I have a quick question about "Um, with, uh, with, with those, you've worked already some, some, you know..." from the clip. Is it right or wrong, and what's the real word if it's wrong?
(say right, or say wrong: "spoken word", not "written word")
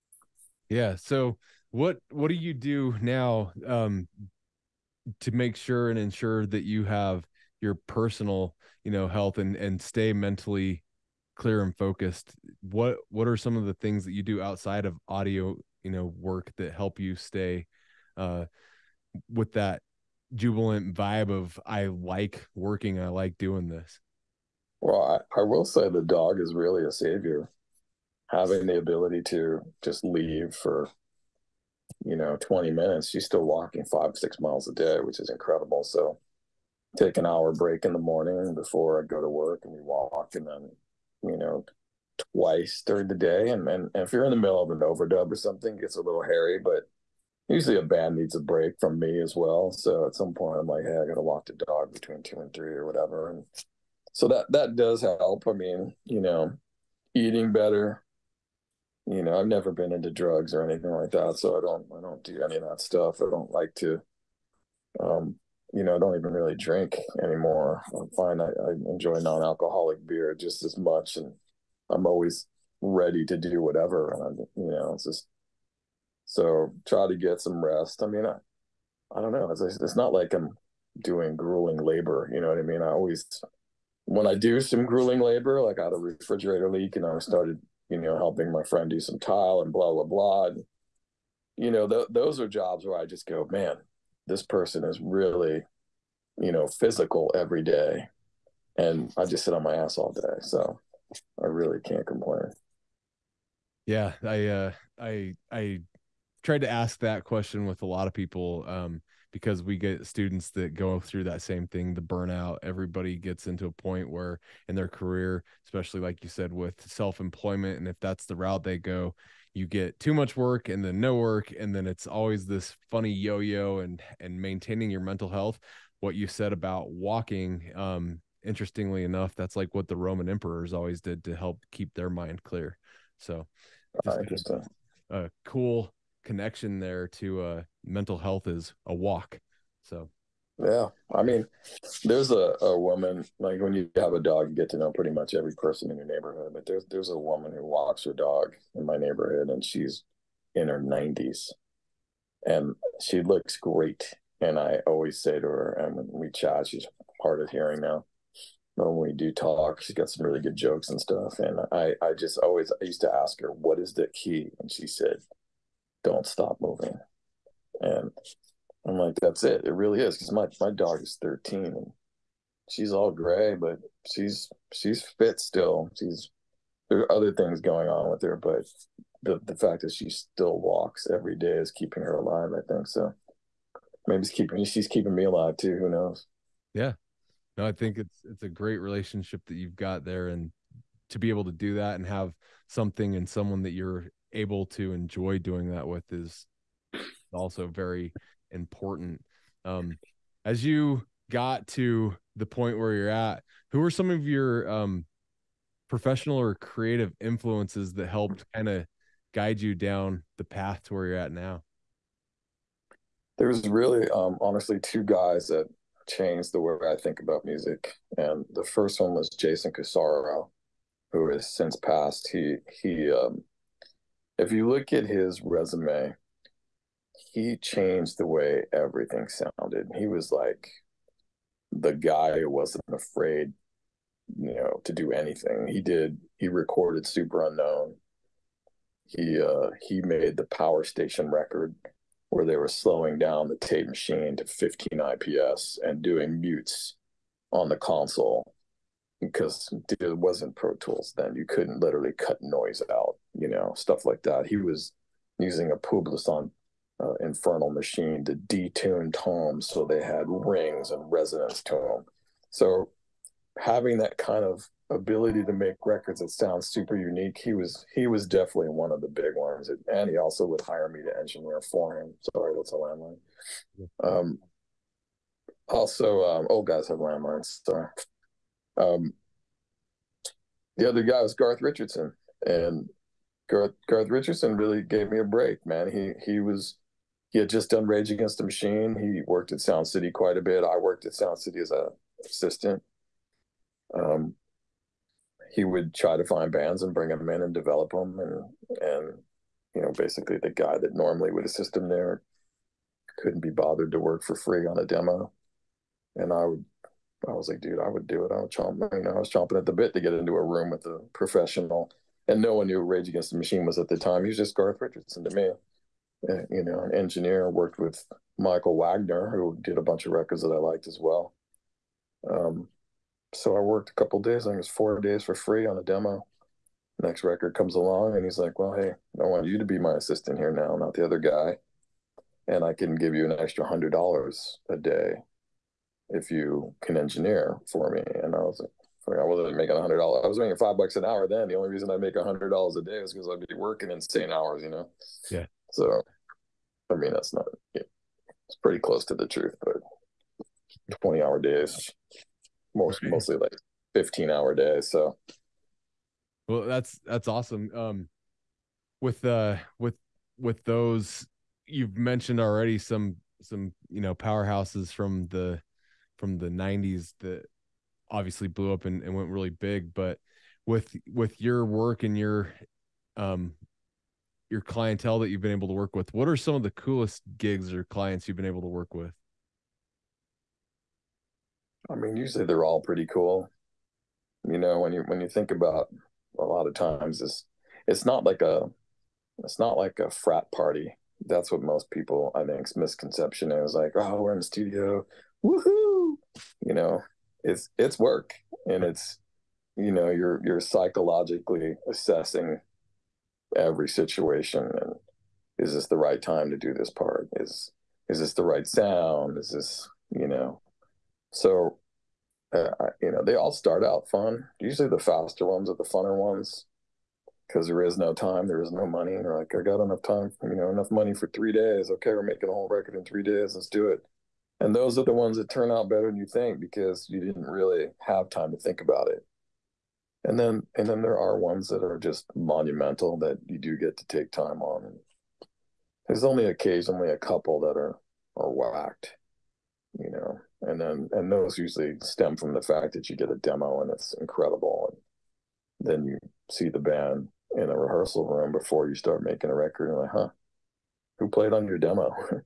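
wrong: "mentioned", not "worked".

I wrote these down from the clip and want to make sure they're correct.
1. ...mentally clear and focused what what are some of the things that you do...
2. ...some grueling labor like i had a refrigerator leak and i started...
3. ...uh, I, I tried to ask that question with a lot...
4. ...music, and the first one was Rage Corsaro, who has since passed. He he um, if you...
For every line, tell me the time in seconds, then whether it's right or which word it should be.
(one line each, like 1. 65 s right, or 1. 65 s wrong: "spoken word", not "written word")
1. 10 s right
2. 84 s right
3. 104 s right
4. 217 s wrong: "Jason", not "Rage".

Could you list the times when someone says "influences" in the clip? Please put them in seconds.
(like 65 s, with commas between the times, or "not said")
207 s.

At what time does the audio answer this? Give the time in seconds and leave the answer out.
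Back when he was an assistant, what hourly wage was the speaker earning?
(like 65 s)
340 s.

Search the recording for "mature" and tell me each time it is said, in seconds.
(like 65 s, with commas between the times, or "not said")
not said.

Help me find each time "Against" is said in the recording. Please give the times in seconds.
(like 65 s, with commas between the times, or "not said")
288 s, 313 s.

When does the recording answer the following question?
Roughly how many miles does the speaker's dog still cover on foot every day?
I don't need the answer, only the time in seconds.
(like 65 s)
33 s.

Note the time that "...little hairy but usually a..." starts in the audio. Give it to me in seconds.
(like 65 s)
46 s.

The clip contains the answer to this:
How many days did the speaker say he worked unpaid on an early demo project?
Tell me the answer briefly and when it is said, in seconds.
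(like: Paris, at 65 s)
4 days, at 324 s.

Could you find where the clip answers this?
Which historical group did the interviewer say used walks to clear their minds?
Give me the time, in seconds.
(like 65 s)
129 s.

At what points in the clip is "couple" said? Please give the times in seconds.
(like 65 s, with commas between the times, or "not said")
323 s, 437 s.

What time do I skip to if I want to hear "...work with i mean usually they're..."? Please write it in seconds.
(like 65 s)
378 s.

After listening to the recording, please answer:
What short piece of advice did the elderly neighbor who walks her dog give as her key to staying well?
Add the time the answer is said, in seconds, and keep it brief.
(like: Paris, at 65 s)
Don't stop moving, at 166 s.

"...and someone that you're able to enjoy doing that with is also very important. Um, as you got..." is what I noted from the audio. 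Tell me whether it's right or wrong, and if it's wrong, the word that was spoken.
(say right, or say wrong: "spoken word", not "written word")
right.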